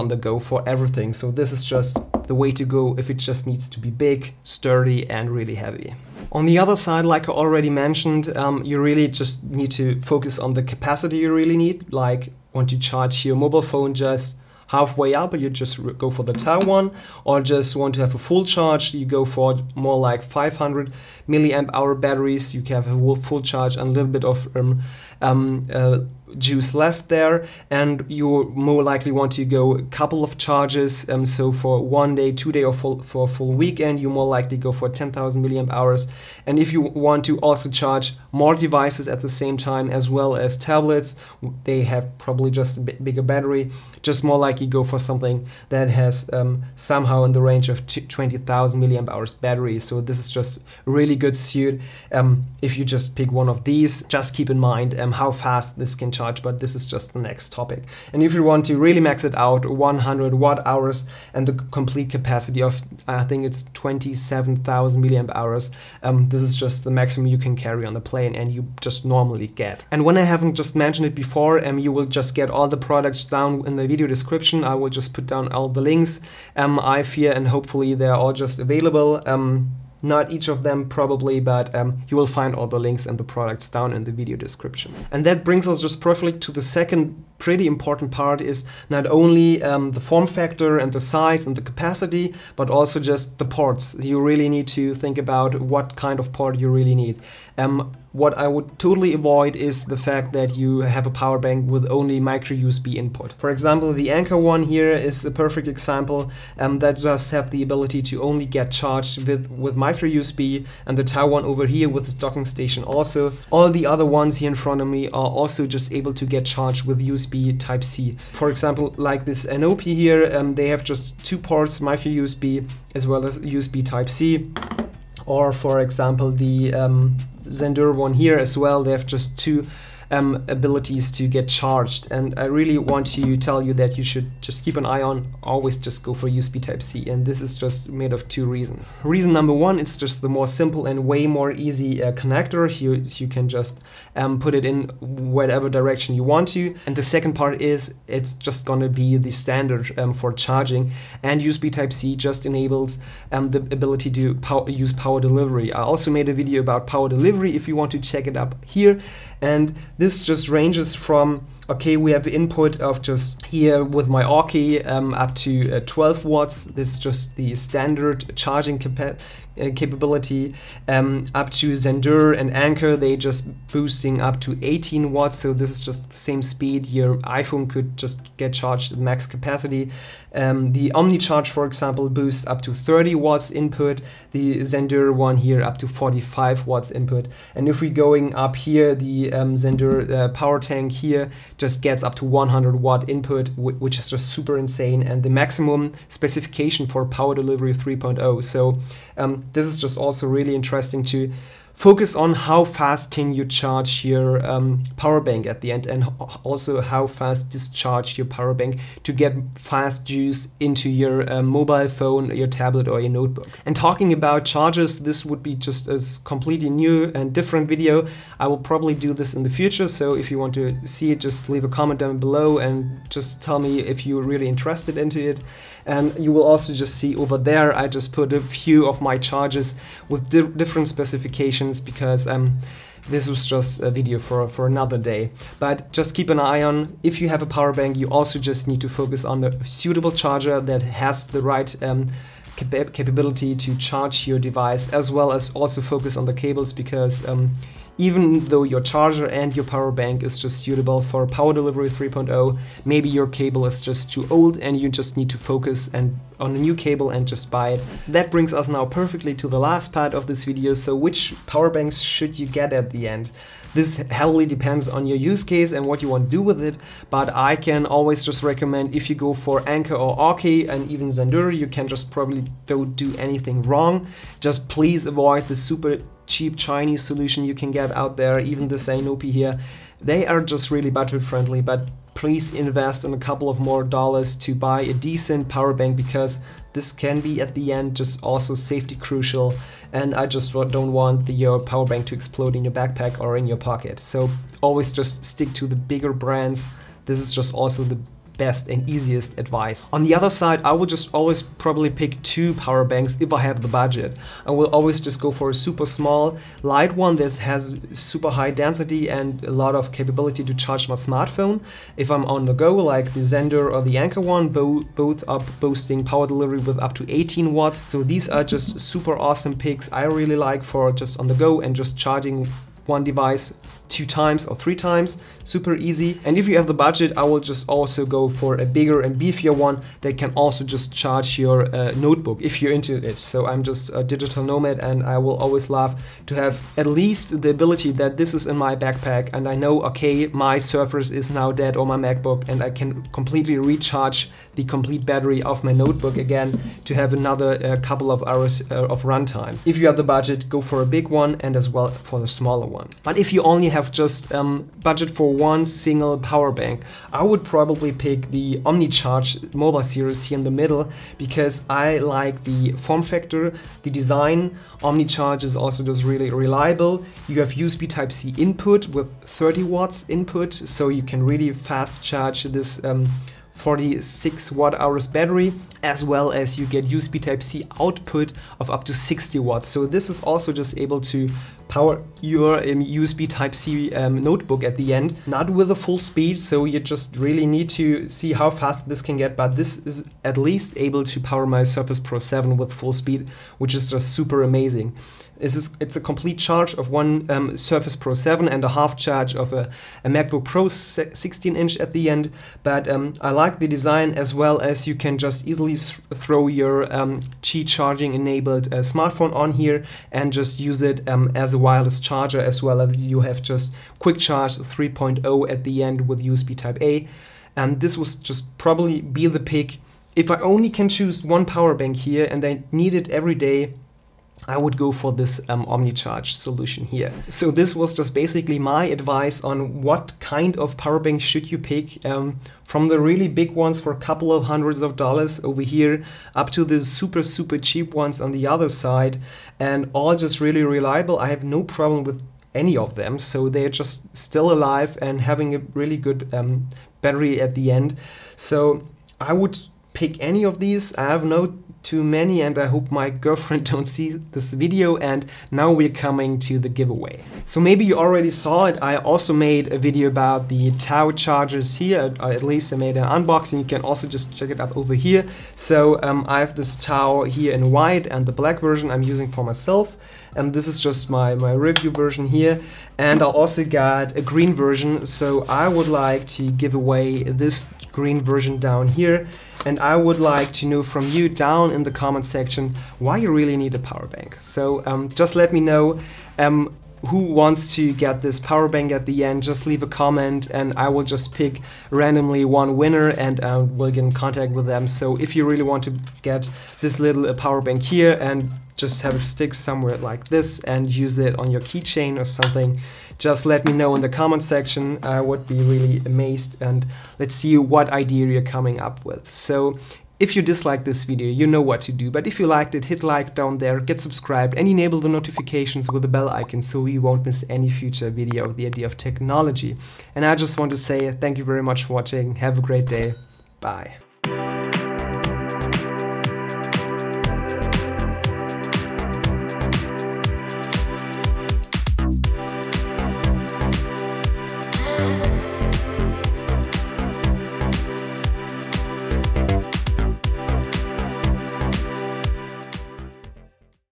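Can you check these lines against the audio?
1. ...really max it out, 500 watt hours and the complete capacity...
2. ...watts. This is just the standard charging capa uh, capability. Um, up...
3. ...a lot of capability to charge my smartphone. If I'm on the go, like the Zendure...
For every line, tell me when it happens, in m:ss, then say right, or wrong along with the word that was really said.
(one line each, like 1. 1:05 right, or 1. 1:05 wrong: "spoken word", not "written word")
1. 0:58 wrong: "100", not "500"
2. 2:46 right
3. 5:09 right.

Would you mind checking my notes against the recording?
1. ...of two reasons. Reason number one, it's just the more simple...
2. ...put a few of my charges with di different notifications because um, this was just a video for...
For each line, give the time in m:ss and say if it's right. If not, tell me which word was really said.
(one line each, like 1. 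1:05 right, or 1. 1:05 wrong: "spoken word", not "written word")
1. 2:18 right
2. 3:48 wrong: "specifications", not "notifications".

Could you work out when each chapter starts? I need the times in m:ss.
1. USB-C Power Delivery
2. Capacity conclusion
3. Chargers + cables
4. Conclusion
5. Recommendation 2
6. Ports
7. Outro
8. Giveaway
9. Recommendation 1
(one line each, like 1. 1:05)
1. 2:19
2. 0:06
3. 3:23
4. 7:06
5. 5:52
6. 1:24
7. 8:30
8. 7:37
9. 4:17.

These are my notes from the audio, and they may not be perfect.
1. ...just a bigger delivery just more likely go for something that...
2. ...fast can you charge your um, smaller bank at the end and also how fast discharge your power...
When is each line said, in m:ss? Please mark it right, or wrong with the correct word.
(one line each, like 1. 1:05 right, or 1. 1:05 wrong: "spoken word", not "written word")
1. 0:42 wrong: "battery", not "delivery"
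2. 3:22 wrong: "power", not "smaller".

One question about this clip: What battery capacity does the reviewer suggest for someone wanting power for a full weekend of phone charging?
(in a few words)
10000 mAh.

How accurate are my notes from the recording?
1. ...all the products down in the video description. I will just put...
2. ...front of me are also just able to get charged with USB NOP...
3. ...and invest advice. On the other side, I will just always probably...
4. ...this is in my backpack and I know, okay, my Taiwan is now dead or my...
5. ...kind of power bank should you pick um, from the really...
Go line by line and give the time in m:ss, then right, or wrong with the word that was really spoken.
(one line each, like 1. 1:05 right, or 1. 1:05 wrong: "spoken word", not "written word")
1. 1:12 right
2. 1:54 wrong: "USB", not "NOP"
3. 4:58 wrong: "easiest", not "invest"
4. 5:38 wrong: "Surface", not "Taiwan"
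5. 7:10 right.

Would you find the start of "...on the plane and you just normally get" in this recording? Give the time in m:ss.
1:07.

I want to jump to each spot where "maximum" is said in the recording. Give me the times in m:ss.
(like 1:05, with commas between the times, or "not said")
1:06, 3:15.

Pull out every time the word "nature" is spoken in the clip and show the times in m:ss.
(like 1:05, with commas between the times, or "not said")
not said.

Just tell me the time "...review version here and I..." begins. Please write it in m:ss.
7:51.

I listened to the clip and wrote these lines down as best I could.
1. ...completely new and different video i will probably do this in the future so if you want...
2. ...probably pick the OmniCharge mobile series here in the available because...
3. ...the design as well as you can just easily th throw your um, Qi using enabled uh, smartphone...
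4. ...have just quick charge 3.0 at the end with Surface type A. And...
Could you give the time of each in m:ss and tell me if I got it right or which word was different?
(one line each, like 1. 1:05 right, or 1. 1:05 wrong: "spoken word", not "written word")
1. 3:36 right
2. 5:57 wrong: "middle", not "available"
3. 6:43 wrong: "charging", not "using"
4. 6:53 wrong: "USB", not "Surface".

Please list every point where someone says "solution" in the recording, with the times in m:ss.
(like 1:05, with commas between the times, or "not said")
4:37, 7:06.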